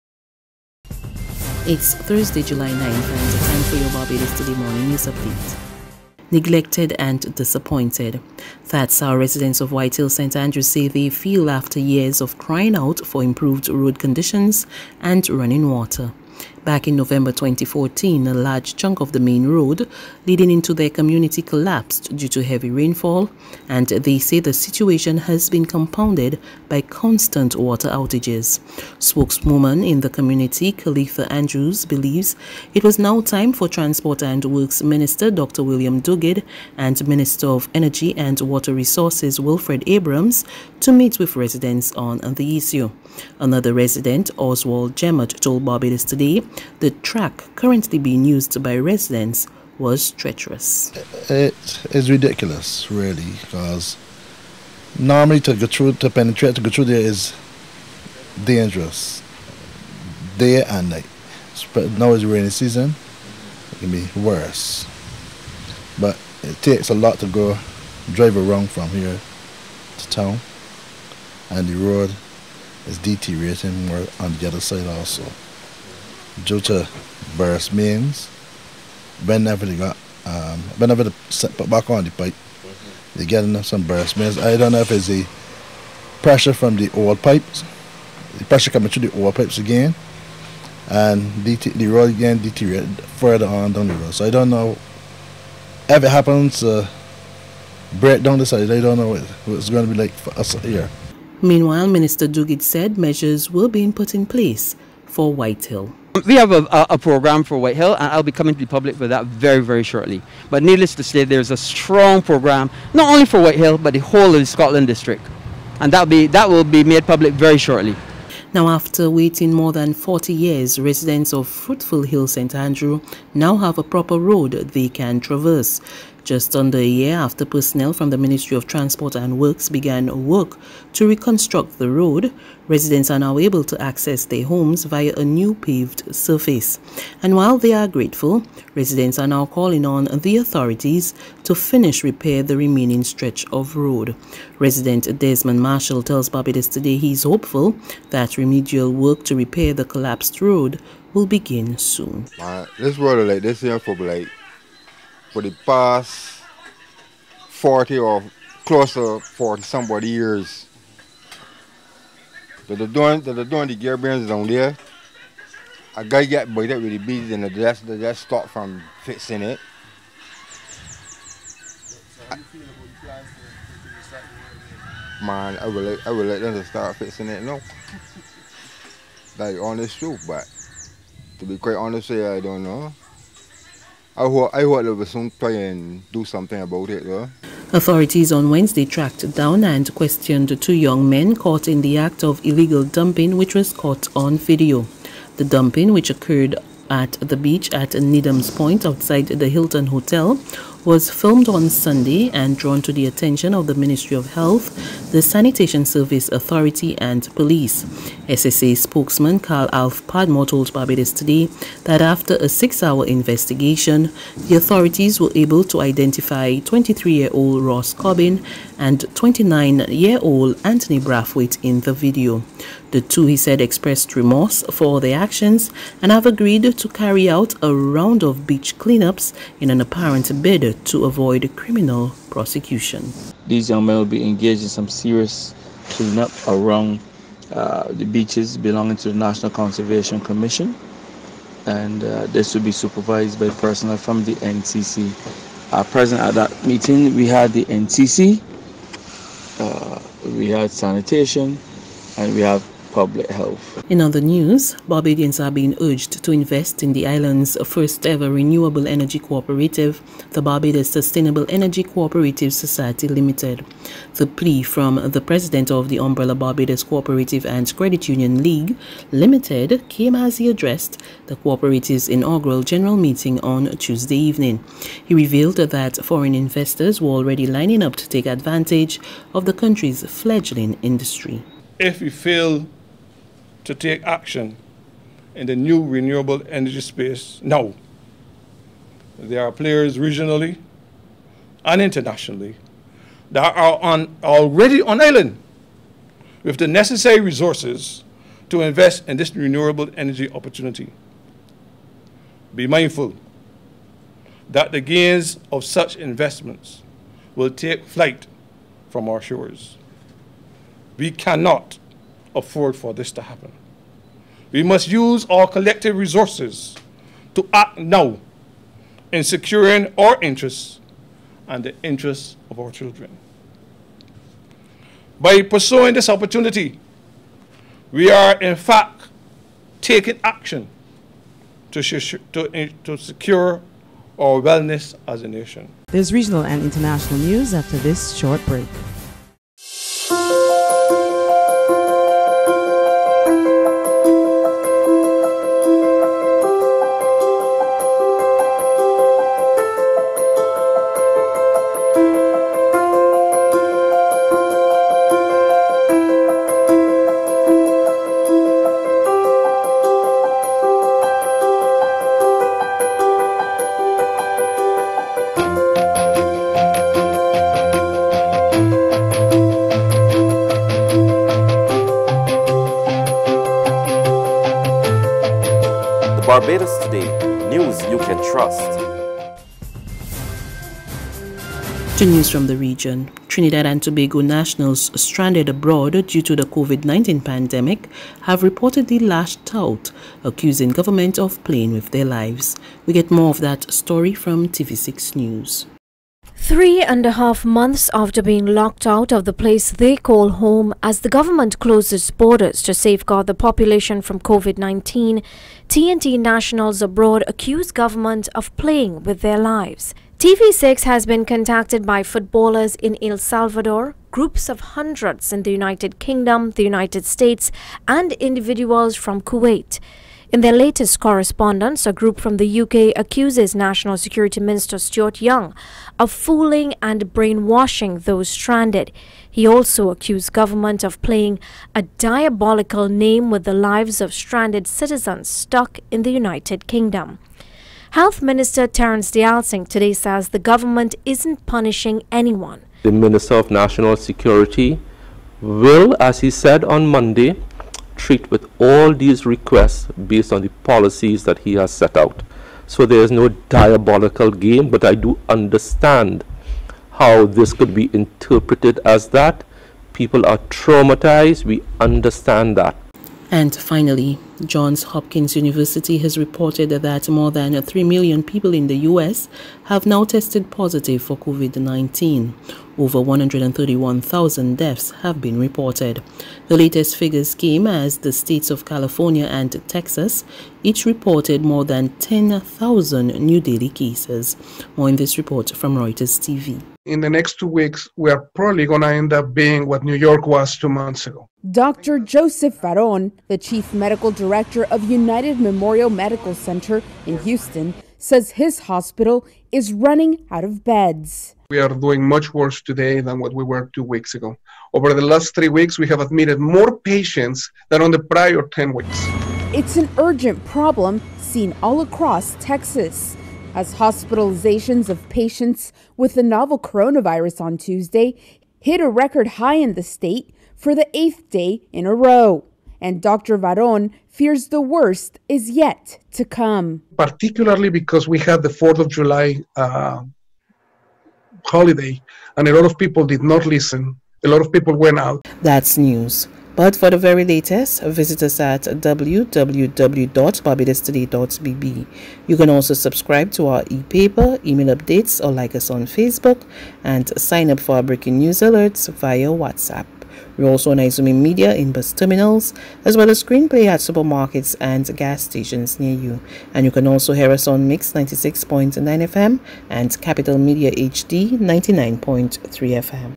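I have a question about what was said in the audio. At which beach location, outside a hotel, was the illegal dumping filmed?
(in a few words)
Needham's Point.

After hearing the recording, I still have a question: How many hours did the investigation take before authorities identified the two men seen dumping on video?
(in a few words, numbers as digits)
6.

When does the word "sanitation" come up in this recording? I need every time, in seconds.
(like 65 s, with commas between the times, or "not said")
205 s, 250 s.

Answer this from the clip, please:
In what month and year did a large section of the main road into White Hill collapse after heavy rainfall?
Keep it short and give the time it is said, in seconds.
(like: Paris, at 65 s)
November 2014, at 16 s.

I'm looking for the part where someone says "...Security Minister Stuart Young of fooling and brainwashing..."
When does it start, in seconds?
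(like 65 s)
423 s.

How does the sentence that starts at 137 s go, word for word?
And while they are grateful, residents are now calling on the authorities to finish repair the remaining stretch of road.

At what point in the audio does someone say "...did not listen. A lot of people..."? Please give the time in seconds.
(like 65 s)
533 s.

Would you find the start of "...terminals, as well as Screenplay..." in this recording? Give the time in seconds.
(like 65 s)
551 s.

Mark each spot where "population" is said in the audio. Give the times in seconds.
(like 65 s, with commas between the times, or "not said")
403 s.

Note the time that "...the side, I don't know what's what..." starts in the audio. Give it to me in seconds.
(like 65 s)
98 s.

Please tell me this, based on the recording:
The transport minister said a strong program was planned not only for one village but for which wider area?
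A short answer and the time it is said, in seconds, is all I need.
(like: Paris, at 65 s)
Scotland district, at 114 s.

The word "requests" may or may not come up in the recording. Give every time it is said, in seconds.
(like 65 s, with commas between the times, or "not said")
449 s.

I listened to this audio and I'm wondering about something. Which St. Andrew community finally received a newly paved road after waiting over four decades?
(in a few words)
Fruitful Hill.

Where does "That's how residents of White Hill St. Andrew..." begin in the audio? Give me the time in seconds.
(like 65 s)
8 s.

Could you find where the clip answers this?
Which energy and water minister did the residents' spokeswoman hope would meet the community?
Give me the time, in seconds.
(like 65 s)
39 s.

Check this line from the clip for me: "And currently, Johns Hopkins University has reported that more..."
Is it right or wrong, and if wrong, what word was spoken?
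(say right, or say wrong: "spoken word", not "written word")
wrong: "finally", not "currently".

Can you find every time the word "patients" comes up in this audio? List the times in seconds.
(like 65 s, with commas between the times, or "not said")
506 s, 515 s.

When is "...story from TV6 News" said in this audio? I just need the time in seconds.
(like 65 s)
393 s.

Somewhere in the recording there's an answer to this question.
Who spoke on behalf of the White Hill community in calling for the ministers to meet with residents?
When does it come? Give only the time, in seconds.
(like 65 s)
30 s.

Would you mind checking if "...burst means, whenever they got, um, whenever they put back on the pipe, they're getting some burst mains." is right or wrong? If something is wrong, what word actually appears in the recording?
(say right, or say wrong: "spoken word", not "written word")
right.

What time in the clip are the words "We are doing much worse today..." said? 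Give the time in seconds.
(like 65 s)
501 s.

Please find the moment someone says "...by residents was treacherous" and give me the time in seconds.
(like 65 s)
48 s.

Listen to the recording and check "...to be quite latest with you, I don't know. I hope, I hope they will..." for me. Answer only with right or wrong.
wrong.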